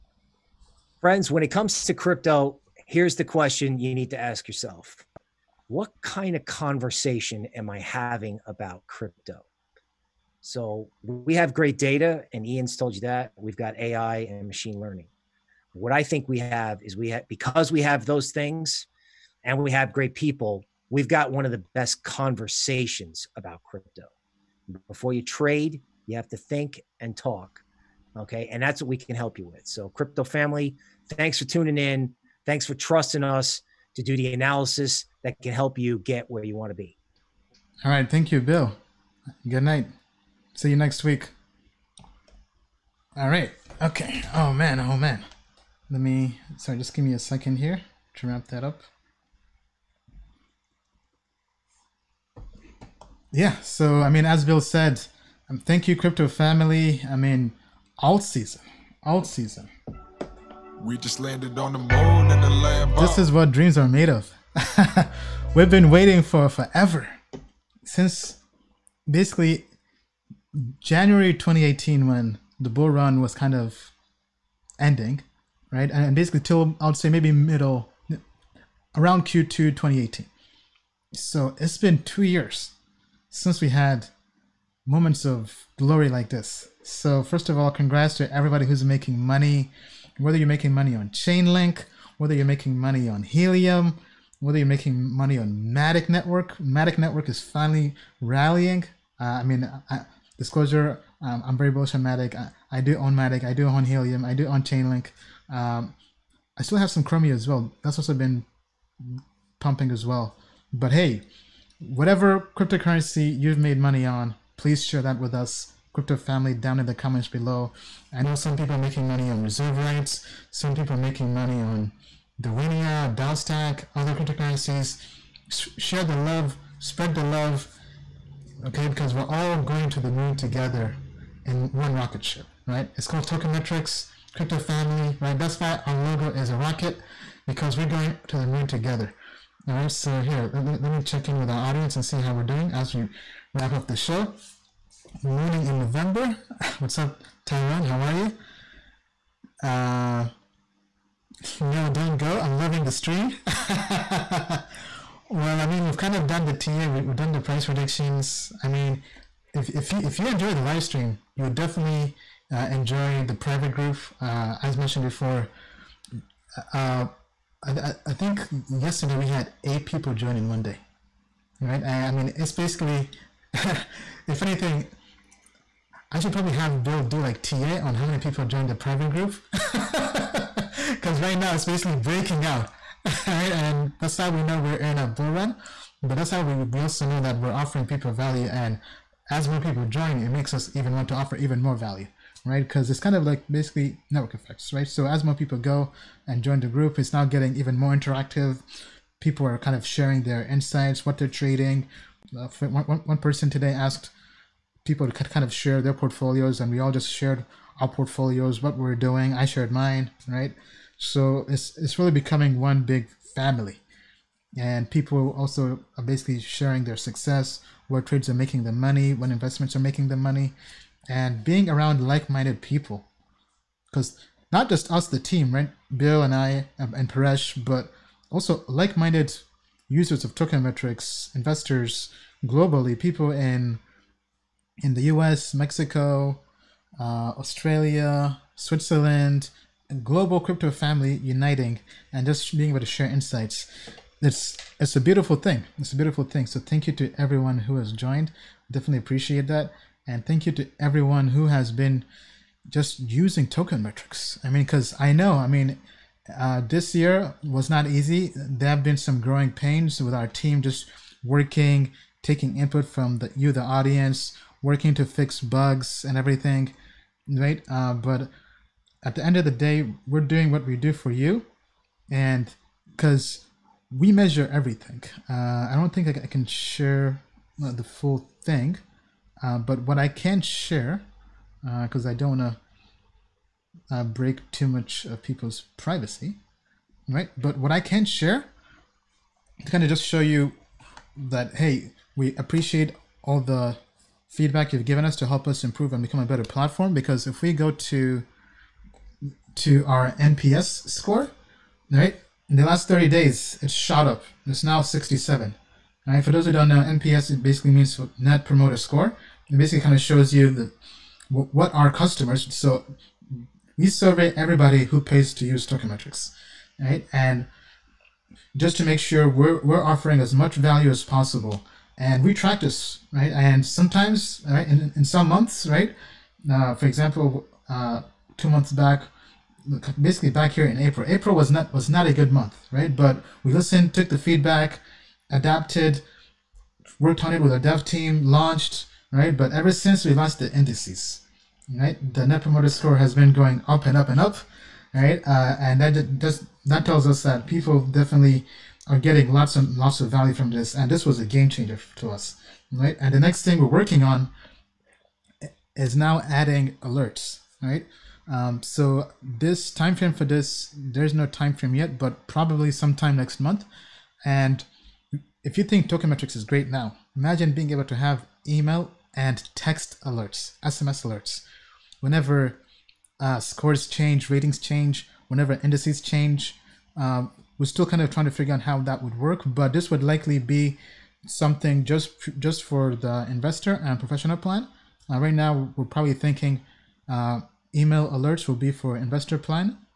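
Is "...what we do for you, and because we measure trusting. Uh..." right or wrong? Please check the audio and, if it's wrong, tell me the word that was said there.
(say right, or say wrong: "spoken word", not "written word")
wrong: "everything", not "trusting".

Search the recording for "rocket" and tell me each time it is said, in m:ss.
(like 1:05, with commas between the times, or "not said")
2:11, 2:16.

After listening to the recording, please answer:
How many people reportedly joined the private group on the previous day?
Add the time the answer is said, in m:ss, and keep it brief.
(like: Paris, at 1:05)
8, at 2:49.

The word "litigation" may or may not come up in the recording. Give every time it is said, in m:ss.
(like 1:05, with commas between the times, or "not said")
not said.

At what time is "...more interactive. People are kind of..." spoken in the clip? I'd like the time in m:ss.
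3:17.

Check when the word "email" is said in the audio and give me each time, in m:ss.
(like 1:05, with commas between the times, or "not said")
6:08, 6:27.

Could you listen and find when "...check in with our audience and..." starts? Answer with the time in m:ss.
2:21.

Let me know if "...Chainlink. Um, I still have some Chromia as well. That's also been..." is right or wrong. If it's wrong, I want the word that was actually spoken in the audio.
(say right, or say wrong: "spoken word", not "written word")
right.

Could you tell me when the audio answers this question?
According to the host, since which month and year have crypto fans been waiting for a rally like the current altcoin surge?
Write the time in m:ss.
1:10.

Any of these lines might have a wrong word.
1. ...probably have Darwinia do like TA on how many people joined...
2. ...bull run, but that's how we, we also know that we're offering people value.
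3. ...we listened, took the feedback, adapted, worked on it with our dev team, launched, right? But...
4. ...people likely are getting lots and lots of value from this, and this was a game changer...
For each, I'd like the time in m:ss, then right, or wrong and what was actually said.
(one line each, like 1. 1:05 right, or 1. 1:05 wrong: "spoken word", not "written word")
1. 2:56 wrong: "Bill", not "Darwinia"
2. 3:05 right
3. 5:33 right
4. 5:47 wrong: "definitely", not "likely".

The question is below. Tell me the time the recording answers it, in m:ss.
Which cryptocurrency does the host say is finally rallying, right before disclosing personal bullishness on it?
1:36.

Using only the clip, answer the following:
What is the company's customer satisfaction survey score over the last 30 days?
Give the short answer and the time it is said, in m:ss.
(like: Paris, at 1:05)
67, at 5:04.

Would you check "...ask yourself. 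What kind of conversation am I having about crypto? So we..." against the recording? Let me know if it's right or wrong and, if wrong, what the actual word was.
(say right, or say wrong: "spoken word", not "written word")
right.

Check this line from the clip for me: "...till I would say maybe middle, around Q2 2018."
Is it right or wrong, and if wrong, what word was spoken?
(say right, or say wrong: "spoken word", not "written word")
right.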